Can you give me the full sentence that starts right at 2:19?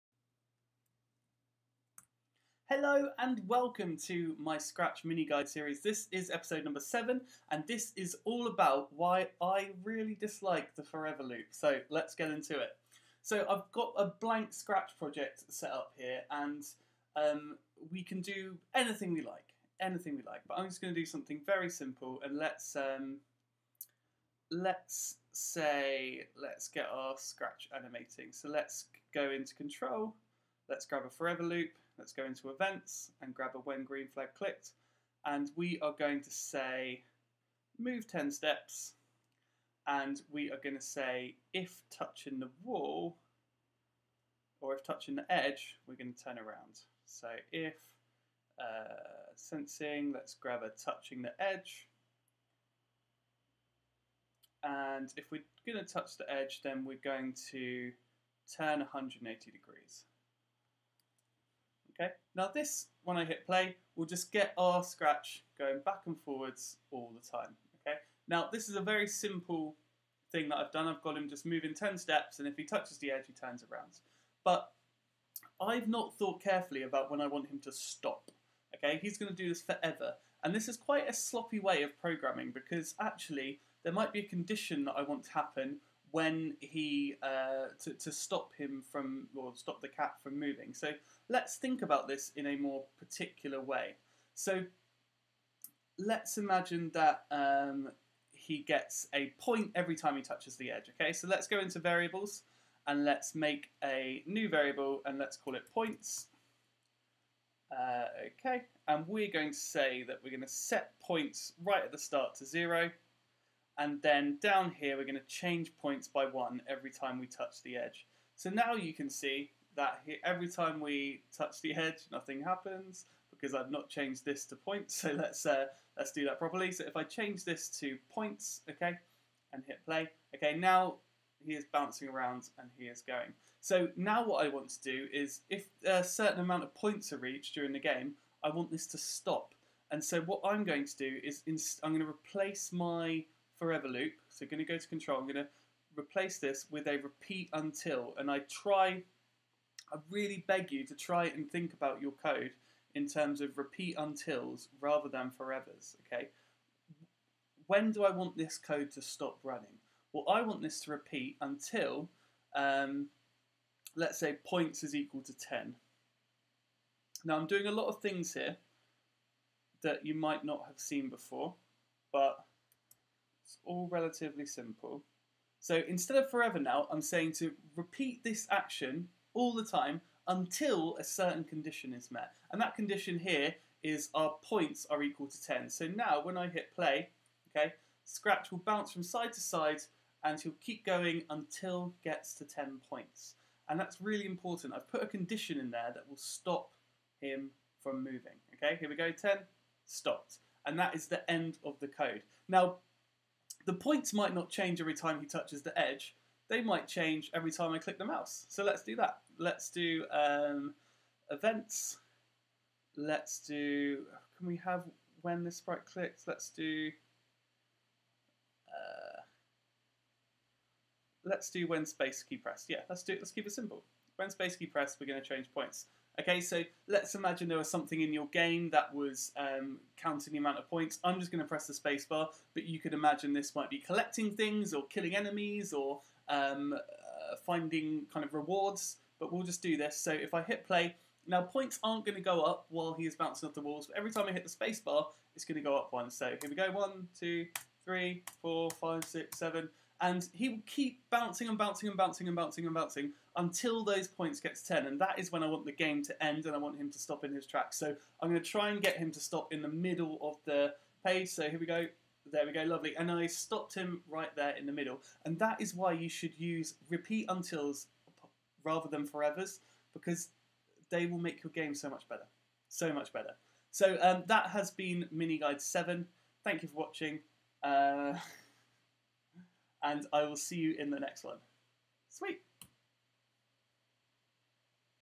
And so what I'm going to do is I'm going to replace my forever loop.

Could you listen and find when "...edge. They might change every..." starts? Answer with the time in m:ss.
3:25.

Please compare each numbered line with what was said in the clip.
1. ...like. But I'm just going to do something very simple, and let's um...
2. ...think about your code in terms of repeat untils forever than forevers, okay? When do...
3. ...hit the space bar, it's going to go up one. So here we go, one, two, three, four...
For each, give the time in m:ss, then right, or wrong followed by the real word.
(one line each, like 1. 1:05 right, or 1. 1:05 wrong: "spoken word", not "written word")
1. 0:20 right
2. 2:31 wrong: "rather", not "forever"
3. 4:04 right.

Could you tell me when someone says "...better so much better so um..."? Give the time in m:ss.
4:32.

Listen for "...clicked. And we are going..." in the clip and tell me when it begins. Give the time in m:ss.
0:34.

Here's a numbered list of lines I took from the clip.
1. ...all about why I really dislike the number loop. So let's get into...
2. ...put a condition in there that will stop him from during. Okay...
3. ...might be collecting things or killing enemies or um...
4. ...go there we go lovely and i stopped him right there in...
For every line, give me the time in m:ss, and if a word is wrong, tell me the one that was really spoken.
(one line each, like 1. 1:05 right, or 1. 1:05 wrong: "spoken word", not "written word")
1. 0:08 wrong: "forever", not "number"
2. 3:14 wrong: "moving", not "during"
3. 3:53 right
4. 4:21 right.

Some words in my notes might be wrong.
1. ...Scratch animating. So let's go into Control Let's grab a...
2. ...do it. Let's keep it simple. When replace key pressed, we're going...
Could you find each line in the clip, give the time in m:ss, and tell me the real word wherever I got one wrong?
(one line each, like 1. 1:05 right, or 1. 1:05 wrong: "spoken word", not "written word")
1. 0:27 right
2. 3:43 wrong: "space", not "replace".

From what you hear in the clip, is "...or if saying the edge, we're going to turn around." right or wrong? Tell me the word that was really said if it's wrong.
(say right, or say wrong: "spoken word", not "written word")
wrong: "touching", not "saying".